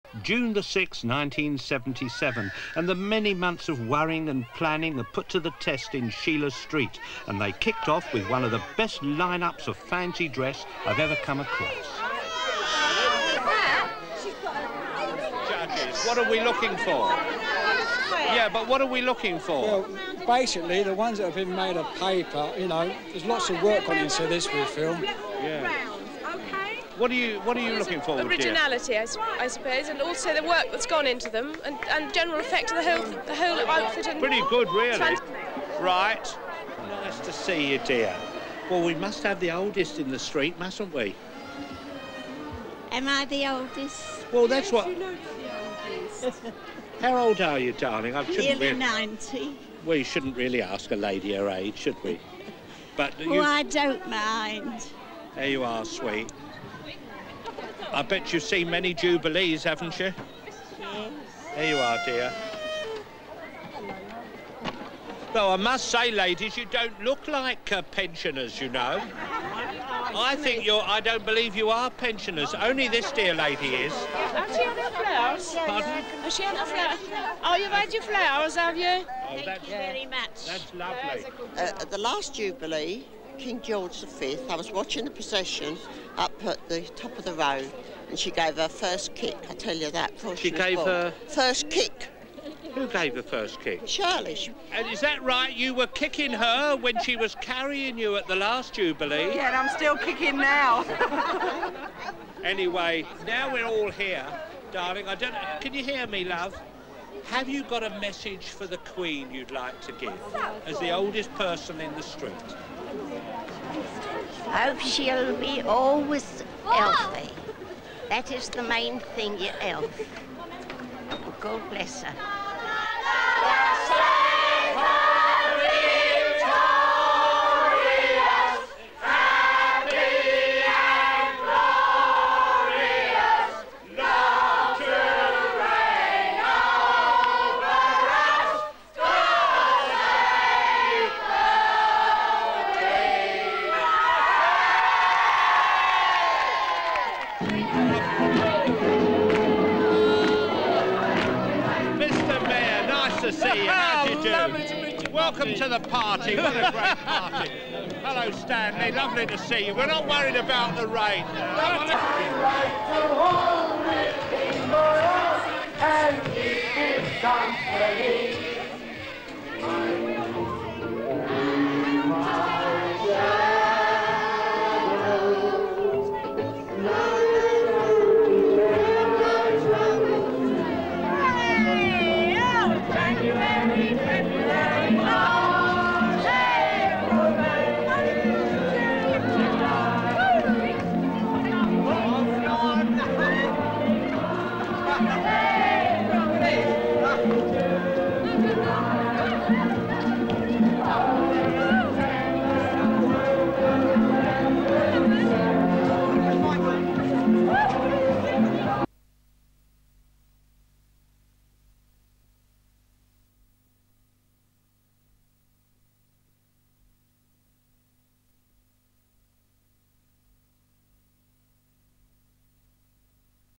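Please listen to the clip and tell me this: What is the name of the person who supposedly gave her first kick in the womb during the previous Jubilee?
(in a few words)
Shirley.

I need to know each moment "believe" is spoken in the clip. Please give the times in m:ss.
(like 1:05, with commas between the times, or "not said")
1:11.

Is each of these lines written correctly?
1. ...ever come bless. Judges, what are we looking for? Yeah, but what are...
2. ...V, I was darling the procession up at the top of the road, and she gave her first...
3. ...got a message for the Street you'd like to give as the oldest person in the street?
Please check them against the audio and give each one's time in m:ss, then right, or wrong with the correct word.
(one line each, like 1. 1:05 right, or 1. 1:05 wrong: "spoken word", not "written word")
1. 0:10 wrong: "across", not "bless"
2. 1:24 wrong: "watching", not "darling"
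3. 1:47 wrong: "Queen", not "Street".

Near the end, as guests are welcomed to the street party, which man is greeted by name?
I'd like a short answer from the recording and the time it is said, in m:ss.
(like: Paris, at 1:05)
Stanley, at 2:38.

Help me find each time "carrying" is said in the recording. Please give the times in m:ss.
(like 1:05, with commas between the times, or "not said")
1:37.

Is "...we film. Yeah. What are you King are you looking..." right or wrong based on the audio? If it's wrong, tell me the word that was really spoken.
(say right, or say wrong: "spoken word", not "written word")
wrong: "What", not "King".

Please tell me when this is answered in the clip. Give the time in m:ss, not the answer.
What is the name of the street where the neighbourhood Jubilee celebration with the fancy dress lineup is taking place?
0:06.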